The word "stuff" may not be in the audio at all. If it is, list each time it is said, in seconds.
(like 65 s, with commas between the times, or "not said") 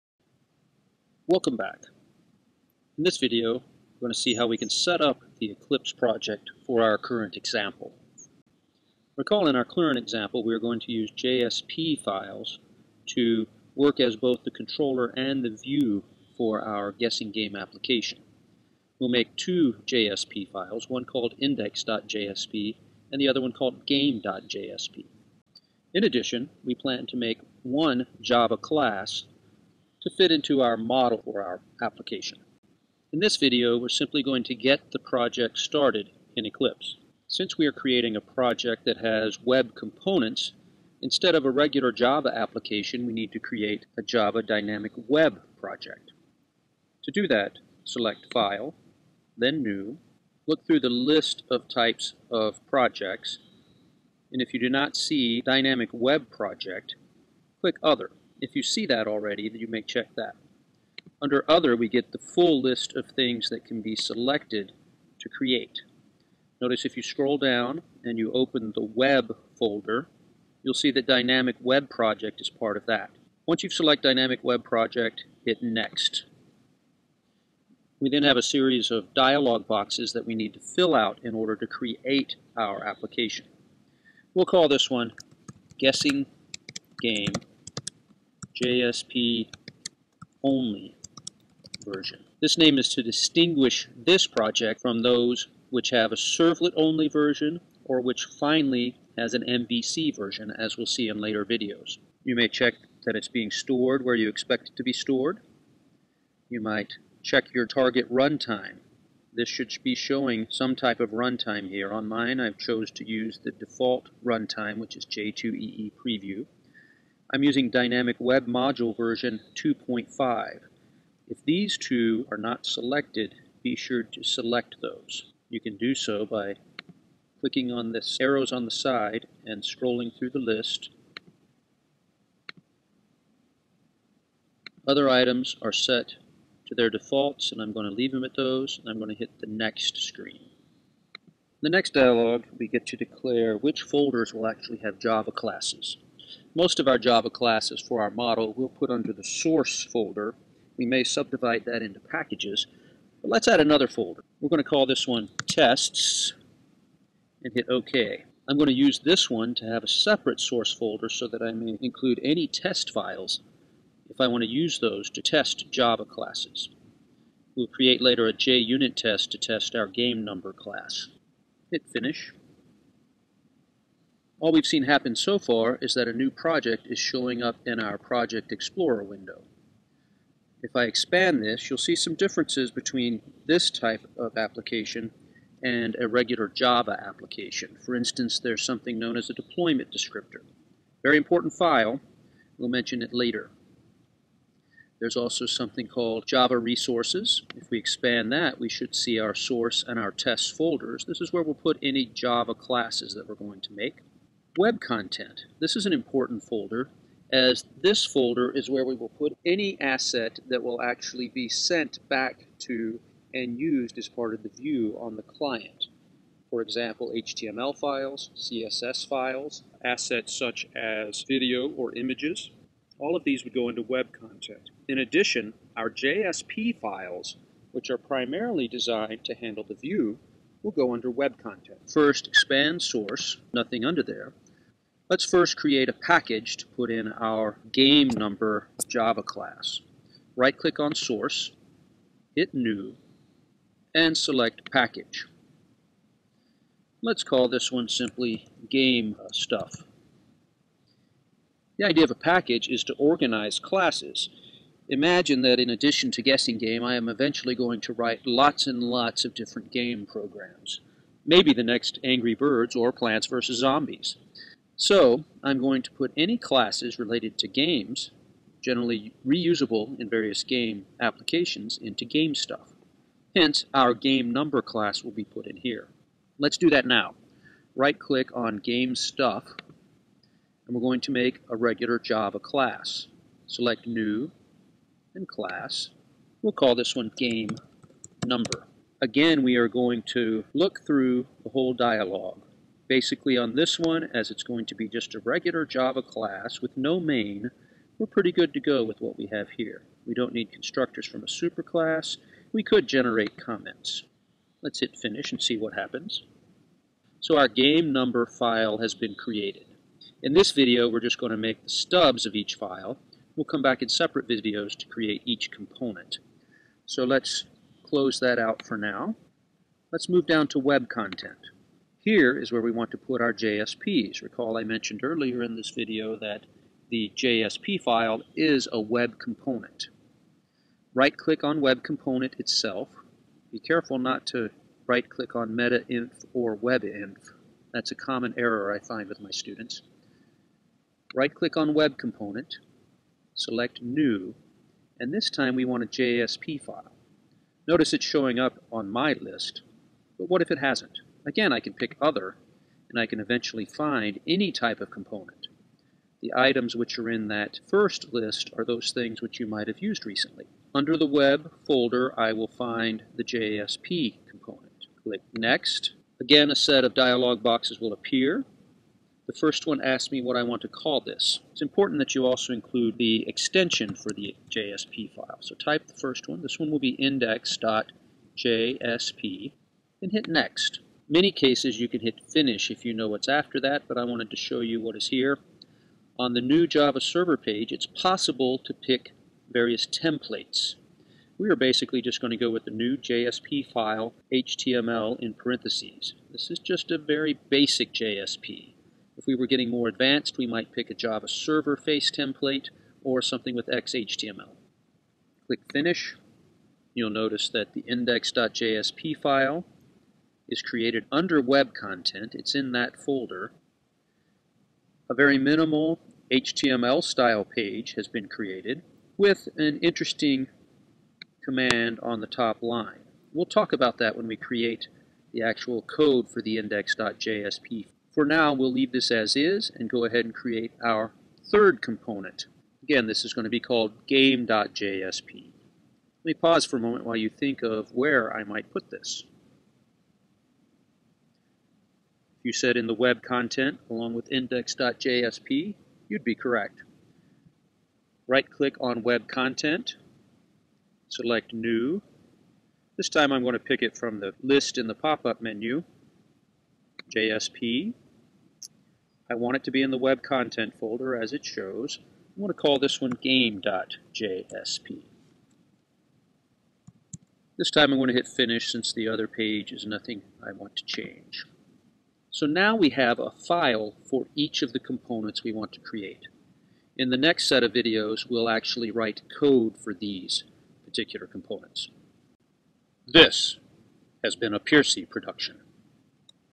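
249 s, 272 s, 278 s.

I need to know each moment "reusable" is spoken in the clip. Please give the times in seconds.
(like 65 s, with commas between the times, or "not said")
269 s.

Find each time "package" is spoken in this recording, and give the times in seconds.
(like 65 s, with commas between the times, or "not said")
152 s, 235 s, 244 s, 252 s.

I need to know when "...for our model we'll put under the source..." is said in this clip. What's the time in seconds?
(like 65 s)
147 s.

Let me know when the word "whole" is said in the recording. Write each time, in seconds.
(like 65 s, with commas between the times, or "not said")
291 s.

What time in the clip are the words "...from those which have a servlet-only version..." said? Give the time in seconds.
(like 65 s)
94 s.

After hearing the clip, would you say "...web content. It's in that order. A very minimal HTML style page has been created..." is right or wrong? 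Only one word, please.
wrong.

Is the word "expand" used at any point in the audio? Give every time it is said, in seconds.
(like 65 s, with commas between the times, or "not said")
180 s, 197 s, 232 s.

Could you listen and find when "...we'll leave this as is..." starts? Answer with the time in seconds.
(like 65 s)
428 s.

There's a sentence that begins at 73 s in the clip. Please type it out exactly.
Once you've selected Dynamic Web Project, hit Next.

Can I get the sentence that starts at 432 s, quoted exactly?
Again, this is going to be called game.jsp.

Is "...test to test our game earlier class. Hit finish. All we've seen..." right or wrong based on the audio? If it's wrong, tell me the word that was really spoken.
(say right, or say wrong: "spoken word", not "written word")
wrong: "number", not "earlier".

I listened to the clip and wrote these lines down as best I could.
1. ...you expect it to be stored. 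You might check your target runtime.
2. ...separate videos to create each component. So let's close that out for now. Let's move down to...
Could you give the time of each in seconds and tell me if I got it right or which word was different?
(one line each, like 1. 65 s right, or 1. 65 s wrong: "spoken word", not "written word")
1. 104 s right
2. 313 s right.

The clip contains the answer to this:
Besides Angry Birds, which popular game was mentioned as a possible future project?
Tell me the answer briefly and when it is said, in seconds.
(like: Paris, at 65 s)
Plants vs. Zombies, at 262 s.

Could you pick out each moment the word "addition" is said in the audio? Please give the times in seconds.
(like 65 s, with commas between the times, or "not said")
26 s, 224 s, 255 s.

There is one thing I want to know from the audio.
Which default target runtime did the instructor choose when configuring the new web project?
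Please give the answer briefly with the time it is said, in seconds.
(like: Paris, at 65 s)
J2EE Preview, at 115 s.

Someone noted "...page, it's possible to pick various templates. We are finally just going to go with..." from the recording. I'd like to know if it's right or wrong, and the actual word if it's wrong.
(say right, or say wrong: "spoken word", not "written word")
wrong: "basically", not "finally".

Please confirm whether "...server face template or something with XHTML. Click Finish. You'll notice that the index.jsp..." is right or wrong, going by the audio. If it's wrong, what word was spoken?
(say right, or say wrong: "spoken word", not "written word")
right.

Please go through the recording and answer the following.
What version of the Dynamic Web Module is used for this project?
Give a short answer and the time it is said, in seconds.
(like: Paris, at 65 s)
2.5, at 119 s.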